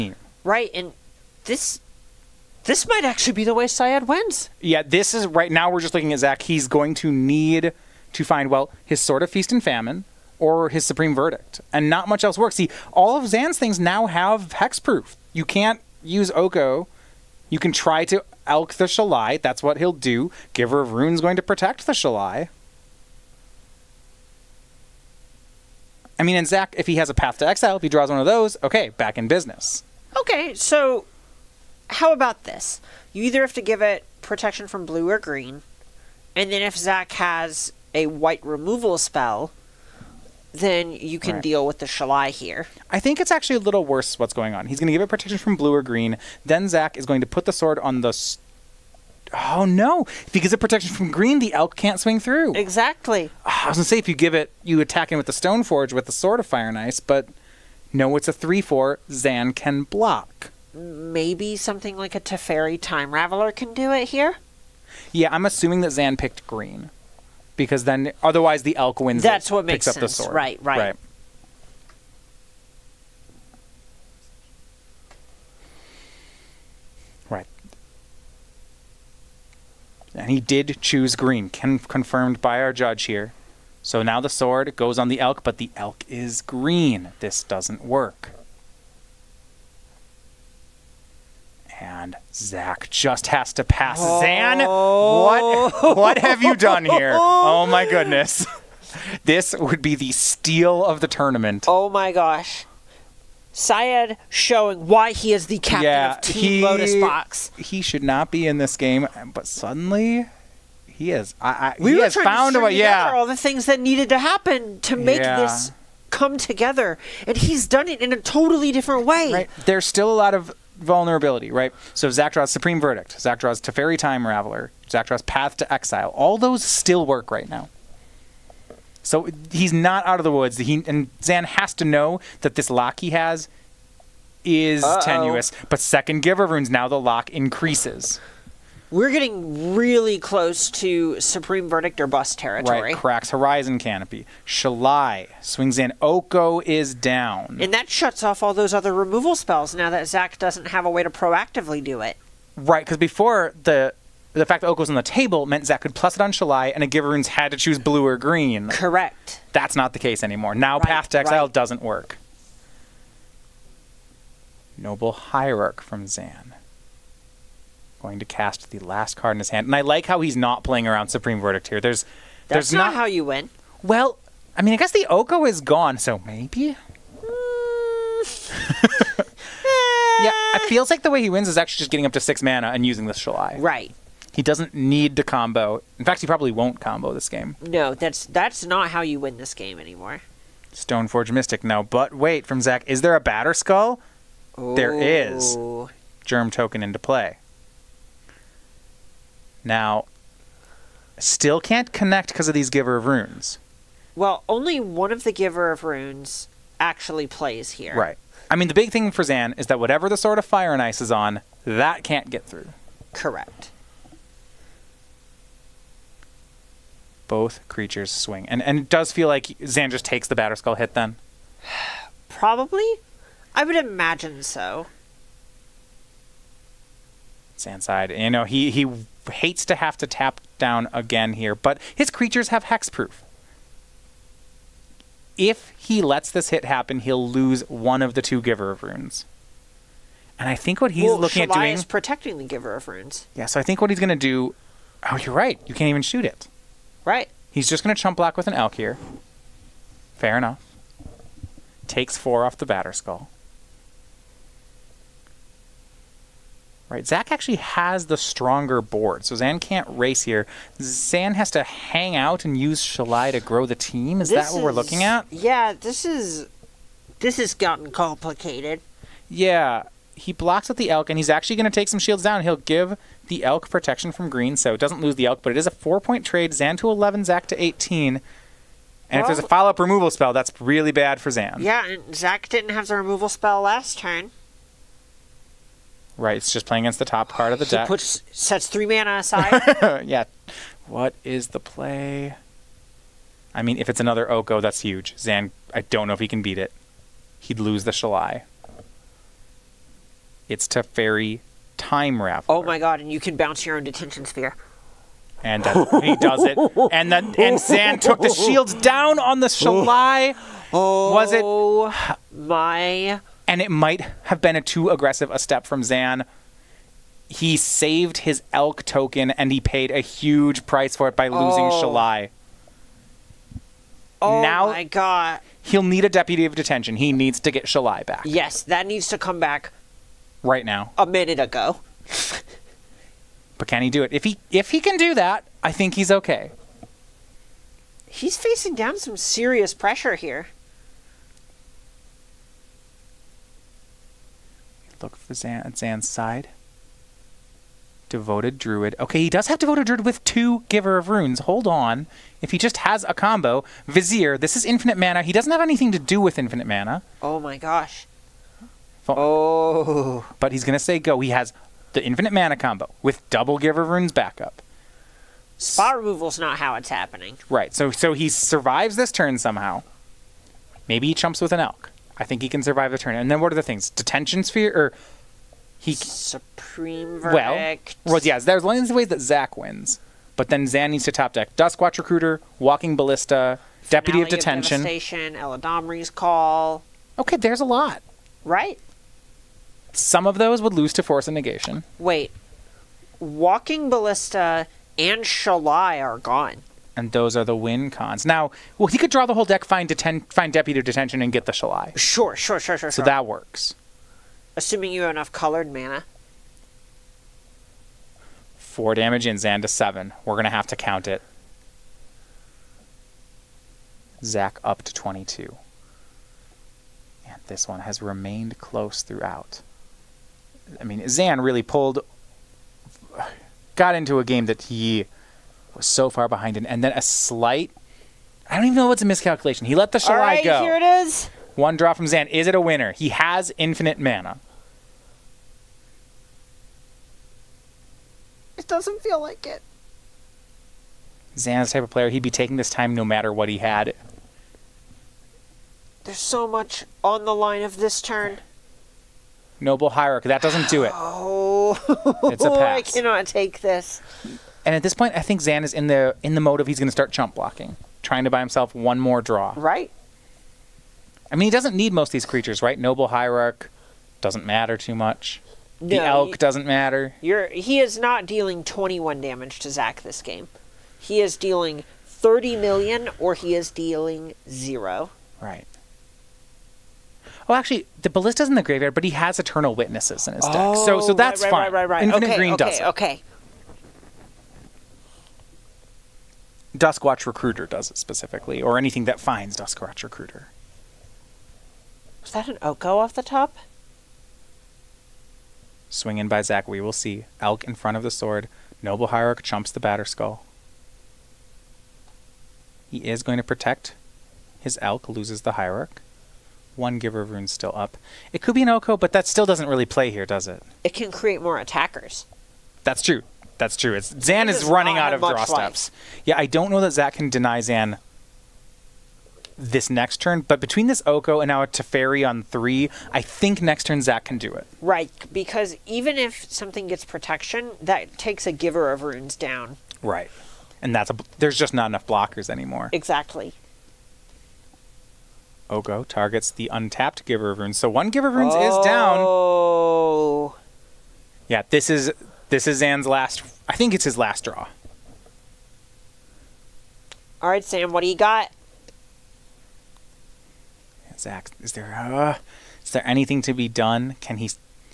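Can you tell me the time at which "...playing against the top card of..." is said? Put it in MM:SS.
04:46.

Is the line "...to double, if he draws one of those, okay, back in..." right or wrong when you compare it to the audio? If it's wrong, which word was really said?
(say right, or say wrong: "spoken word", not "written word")
wrong: "exile", not "double".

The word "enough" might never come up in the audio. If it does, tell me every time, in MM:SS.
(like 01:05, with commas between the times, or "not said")
04:10, 06:45, 08:51.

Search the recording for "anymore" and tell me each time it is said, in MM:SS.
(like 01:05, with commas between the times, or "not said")
02:40, 03:09, 08:52.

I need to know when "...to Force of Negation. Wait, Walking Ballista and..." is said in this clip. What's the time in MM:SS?
06:30.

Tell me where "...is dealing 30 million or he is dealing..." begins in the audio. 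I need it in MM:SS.
07:51.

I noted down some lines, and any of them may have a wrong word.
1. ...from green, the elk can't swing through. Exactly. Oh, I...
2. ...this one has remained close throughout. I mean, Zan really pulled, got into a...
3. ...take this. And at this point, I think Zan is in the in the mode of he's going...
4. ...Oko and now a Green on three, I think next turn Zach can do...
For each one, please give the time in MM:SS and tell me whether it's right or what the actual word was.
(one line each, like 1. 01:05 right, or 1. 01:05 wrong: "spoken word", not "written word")
1. 00:50 right
2. 06:57 right
3. 07:33 right
4. 08:41 wrong: "Teferi", not "Green".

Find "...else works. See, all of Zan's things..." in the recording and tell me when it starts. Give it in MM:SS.
00:12.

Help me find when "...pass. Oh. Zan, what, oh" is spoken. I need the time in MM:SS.
01:33.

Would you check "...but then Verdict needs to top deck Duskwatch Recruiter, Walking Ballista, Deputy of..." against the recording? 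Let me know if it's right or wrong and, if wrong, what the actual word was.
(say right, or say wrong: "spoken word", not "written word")
wrong: "Zan", not "Verdict".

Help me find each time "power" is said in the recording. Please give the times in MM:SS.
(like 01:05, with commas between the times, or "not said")
not said.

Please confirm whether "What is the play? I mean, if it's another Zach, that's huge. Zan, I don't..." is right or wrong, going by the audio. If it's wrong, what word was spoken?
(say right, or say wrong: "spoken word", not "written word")
wrong: "Oko", not "Zach".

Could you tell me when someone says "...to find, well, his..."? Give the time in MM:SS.
00:08.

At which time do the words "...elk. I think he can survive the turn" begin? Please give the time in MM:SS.
06:11.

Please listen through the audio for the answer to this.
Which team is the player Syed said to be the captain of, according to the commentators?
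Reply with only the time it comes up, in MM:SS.
01:46.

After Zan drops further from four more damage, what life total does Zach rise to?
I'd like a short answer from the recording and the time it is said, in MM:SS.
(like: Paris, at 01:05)
22, at 06:54.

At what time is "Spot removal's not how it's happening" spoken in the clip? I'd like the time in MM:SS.
06:05.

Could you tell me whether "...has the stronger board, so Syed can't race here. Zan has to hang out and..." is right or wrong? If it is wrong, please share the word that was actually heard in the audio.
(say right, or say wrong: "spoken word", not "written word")
wrong: "Zan", not "Syed".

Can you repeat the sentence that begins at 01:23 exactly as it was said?
So now the sword goes on the elk, but the elk is green.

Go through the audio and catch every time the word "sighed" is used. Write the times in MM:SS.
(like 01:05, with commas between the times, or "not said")
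03:47.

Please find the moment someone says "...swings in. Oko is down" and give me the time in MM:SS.
02:25.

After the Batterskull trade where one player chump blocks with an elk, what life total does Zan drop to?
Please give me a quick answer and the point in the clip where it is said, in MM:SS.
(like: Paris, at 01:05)
11, at 04:36.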